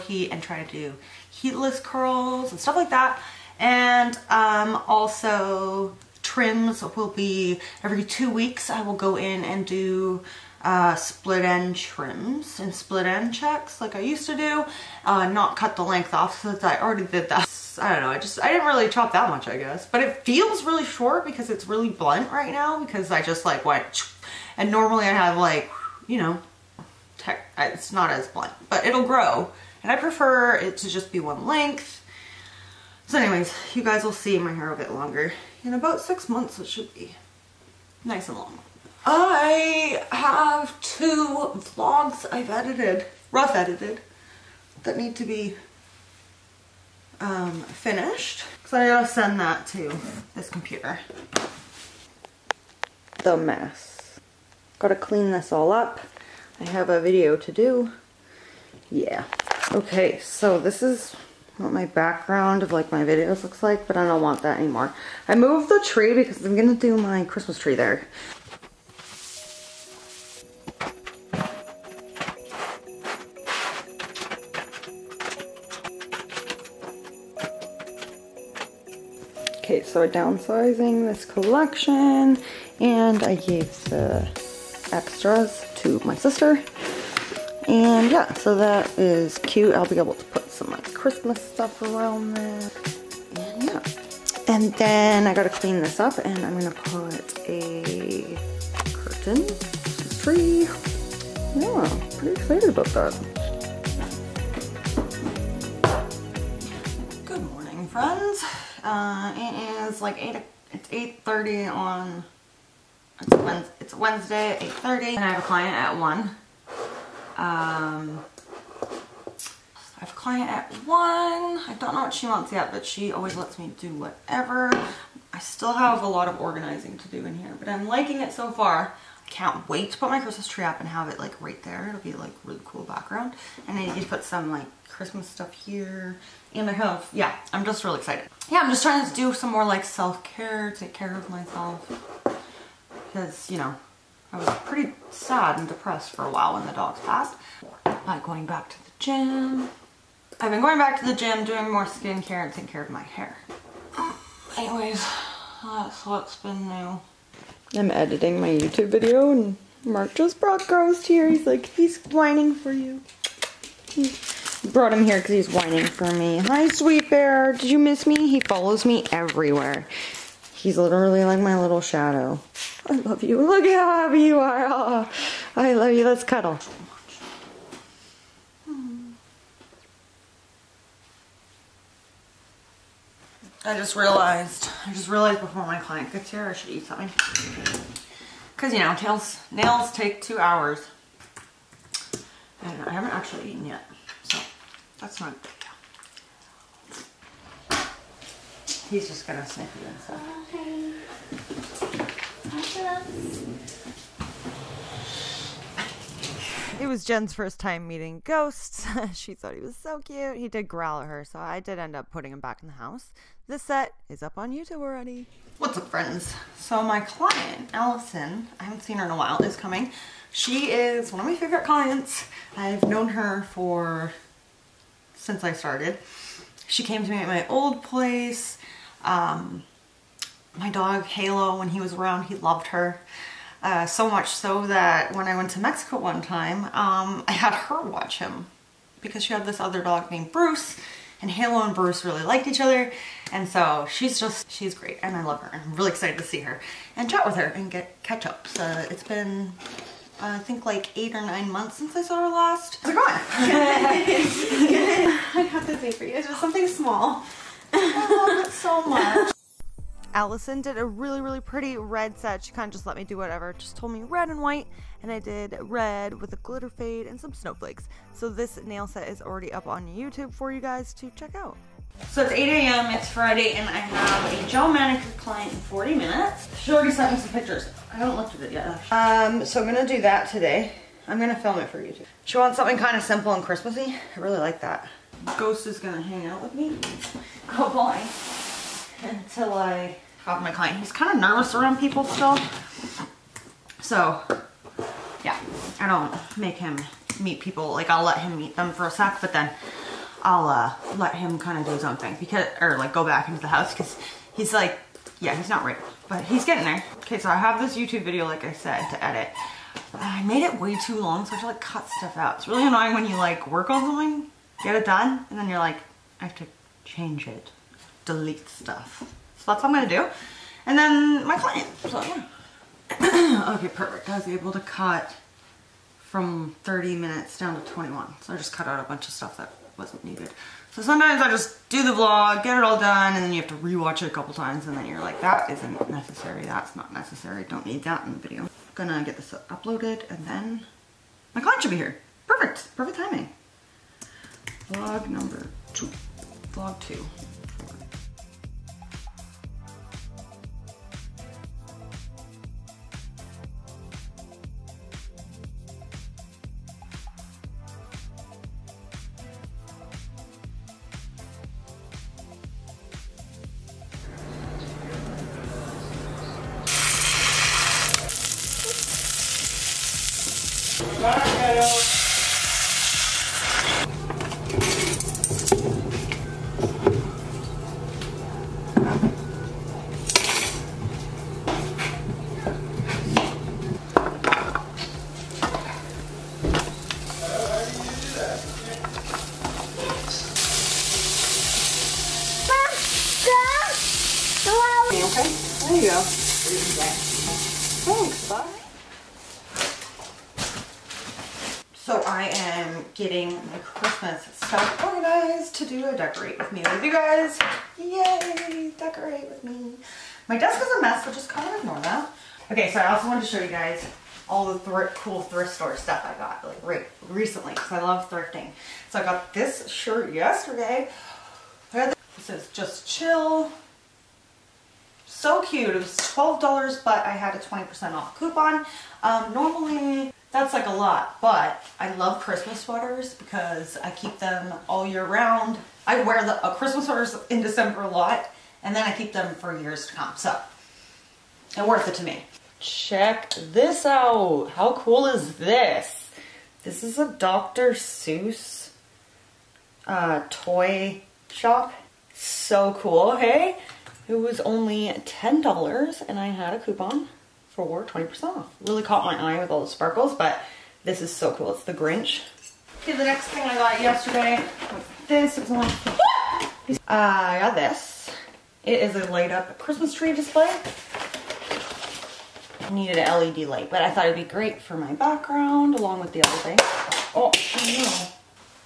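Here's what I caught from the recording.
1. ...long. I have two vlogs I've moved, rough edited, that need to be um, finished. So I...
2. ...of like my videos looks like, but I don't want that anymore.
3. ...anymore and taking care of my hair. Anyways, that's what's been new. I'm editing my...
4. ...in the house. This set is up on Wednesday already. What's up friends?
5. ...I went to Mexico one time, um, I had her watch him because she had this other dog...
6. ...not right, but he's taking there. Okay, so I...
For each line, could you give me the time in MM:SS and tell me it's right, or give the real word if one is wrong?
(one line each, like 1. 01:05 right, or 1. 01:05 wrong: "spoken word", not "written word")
1. 00:38 wrong: "edited", not "moved"
2. 01:02 right
3. 02:31 wrong: "skincare", not "anymore"
4. 03:32 wrong: "YouTube", not "Wednesday"
5. 03:55 right
6. 05:05 wrong: "getting", not "taking".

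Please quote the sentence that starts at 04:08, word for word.
So it's been, uh, I think like eight or nine months since I saw her last.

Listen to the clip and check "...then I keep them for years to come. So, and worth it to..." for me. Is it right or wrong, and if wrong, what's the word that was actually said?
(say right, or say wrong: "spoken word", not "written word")
right.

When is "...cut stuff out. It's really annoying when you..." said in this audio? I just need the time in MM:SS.
05:11.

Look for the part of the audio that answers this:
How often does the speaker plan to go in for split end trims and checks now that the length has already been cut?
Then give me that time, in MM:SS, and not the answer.
00:07.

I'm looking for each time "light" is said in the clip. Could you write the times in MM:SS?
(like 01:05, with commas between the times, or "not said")
07:49, 07:53.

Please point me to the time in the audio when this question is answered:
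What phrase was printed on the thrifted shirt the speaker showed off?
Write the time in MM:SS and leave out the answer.
07:02.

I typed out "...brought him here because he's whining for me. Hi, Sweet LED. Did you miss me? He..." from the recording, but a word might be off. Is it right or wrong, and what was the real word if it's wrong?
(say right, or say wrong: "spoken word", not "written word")
wrong: "Bear", not "LED".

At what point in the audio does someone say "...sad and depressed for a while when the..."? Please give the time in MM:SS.
02:25.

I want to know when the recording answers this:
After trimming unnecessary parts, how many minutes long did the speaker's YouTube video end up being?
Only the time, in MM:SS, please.
05:27.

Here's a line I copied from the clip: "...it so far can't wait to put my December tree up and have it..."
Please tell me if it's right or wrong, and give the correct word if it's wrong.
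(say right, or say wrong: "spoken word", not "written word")
wrong: "Christmas", not "December".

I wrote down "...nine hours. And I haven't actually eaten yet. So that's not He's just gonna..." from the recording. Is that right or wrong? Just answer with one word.
wrong.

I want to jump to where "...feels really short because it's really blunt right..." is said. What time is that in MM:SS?
00:20.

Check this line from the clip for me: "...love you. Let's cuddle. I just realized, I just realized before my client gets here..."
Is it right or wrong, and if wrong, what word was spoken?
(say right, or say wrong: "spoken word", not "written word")
right.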